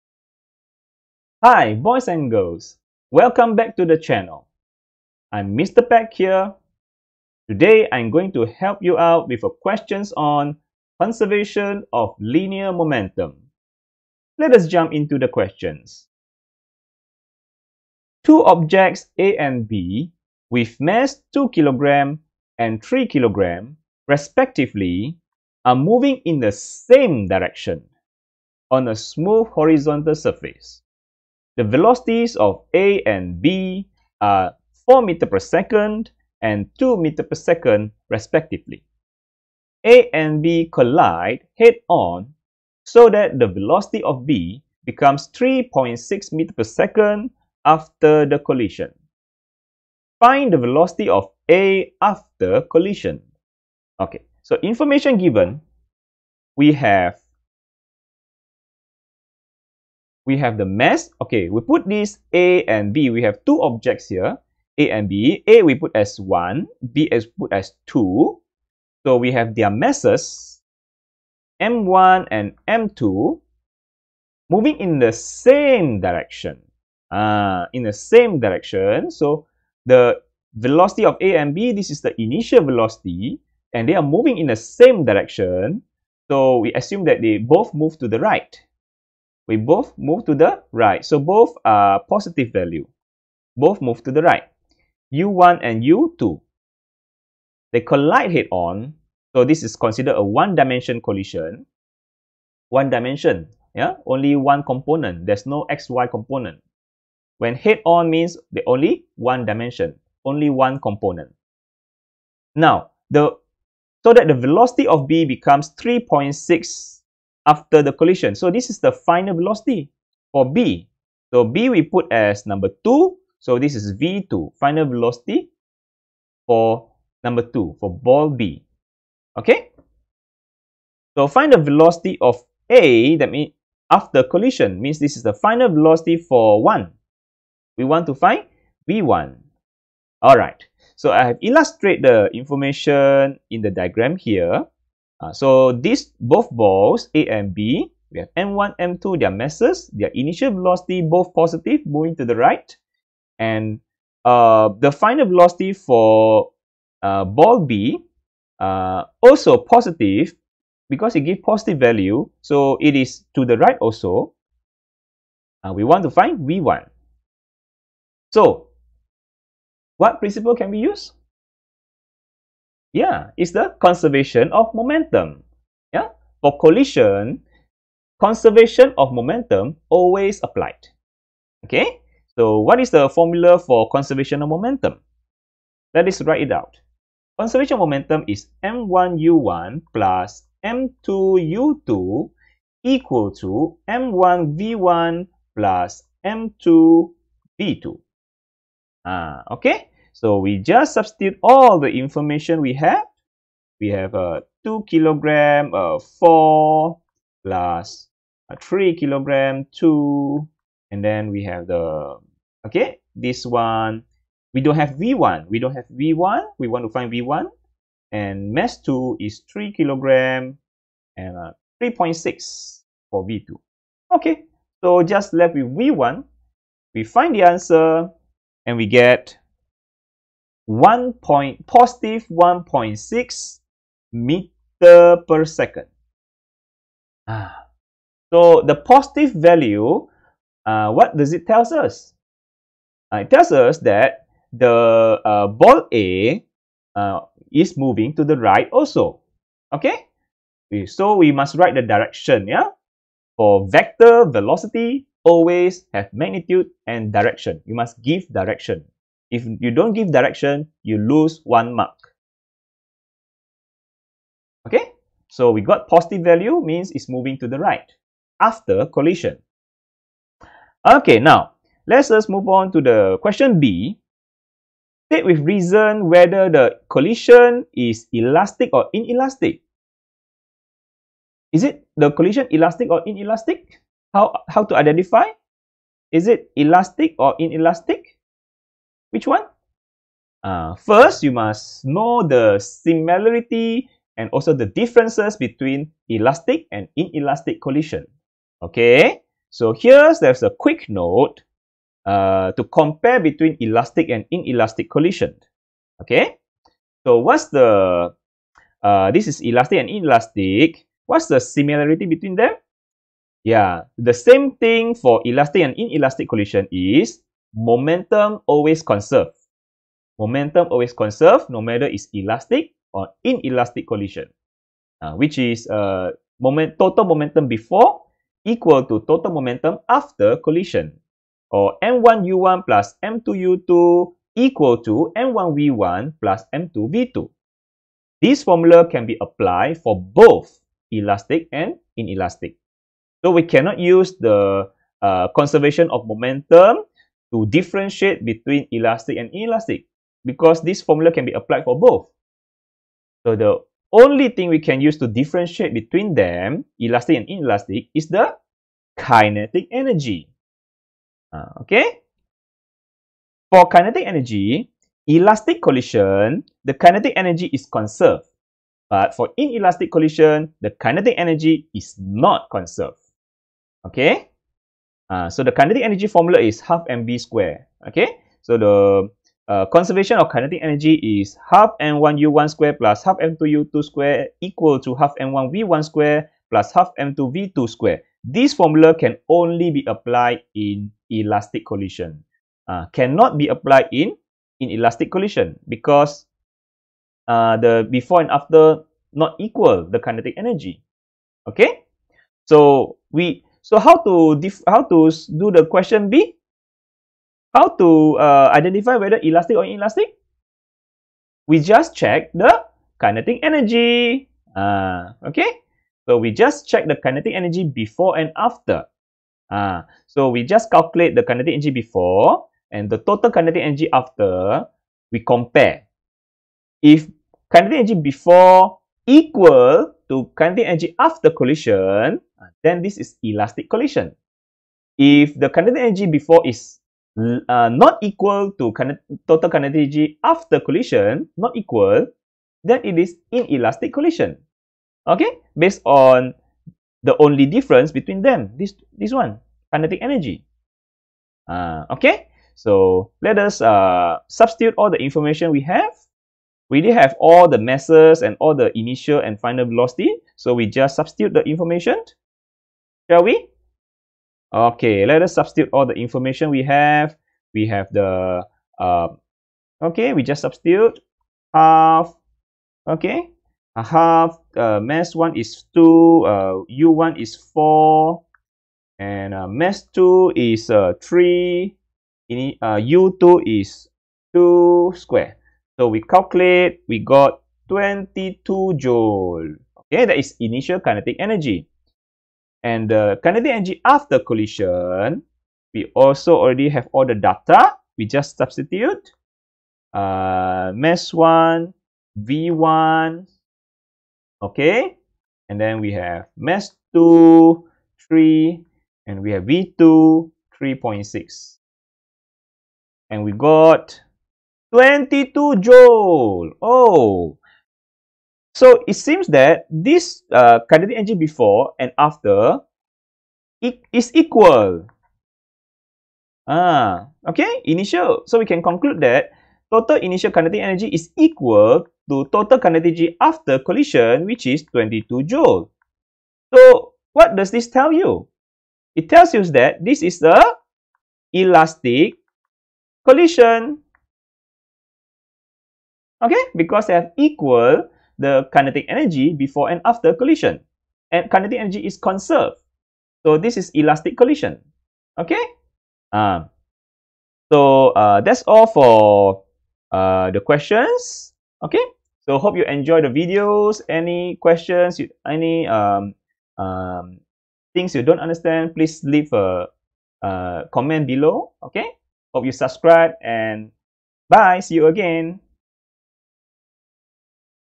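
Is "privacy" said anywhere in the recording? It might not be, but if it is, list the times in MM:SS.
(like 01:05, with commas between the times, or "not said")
not said.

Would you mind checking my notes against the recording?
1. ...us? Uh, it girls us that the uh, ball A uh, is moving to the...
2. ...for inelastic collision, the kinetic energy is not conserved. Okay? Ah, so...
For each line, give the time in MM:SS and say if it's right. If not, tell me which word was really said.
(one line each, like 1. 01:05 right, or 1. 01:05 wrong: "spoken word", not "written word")
1. 04:01 wrong: "tells", not "girls"
2. 06:09 right.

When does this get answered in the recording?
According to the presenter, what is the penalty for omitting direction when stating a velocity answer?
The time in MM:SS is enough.
04:20.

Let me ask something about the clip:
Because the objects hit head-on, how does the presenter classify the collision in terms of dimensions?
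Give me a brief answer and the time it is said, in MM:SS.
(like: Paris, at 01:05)
one-dimension collision, at 01:40.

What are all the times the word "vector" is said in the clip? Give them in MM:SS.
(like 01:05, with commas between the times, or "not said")
04:13.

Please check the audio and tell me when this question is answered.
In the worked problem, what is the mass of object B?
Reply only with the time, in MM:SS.
00:22.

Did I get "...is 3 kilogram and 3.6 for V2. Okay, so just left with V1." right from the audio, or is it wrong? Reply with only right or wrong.
right.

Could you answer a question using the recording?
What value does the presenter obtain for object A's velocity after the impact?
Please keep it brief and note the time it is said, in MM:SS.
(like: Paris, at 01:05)
1.6 m/s, at 03:51.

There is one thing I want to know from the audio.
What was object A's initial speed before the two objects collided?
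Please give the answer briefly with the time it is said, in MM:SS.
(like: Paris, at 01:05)
4 m/s, at 00:34.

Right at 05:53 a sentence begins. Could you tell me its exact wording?
So the only thing we can use to differentiate between them, elastic and inelastic, is the kinetic energy.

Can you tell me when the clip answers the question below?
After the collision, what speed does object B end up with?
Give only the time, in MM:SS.
00:45.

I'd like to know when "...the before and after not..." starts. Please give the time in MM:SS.
06:37.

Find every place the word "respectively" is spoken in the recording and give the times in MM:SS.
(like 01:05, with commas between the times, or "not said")
00:24, 00:38.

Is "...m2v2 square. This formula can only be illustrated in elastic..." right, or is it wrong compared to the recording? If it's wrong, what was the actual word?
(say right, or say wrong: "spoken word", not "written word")
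wrong: "applied", not "illustrated".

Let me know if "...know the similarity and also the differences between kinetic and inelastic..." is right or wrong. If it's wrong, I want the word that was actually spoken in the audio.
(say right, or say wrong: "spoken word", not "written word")
wrong: "elastic", not "kinetic".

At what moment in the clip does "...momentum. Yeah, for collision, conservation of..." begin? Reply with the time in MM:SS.
02:54.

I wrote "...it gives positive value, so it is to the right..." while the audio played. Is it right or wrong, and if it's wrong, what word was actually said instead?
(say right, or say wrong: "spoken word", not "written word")
right.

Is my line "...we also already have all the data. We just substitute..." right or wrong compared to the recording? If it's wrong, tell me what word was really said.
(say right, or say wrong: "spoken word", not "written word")
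right.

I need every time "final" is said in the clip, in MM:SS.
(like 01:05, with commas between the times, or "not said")
01:58, 02:04, 02:15, 02:34, 07:39.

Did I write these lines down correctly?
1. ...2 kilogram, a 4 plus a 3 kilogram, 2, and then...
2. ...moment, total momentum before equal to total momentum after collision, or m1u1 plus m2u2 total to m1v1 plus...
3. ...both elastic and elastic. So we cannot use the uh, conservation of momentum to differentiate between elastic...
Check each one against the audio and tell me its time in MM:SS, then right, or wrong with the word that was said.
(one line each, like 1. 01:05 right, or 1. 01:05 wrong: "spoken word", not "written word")
1. 03:24 right
2. 05:26 wrong: "equal", not "total"
3. 05:39 wrong: "inelastic", not "elastic".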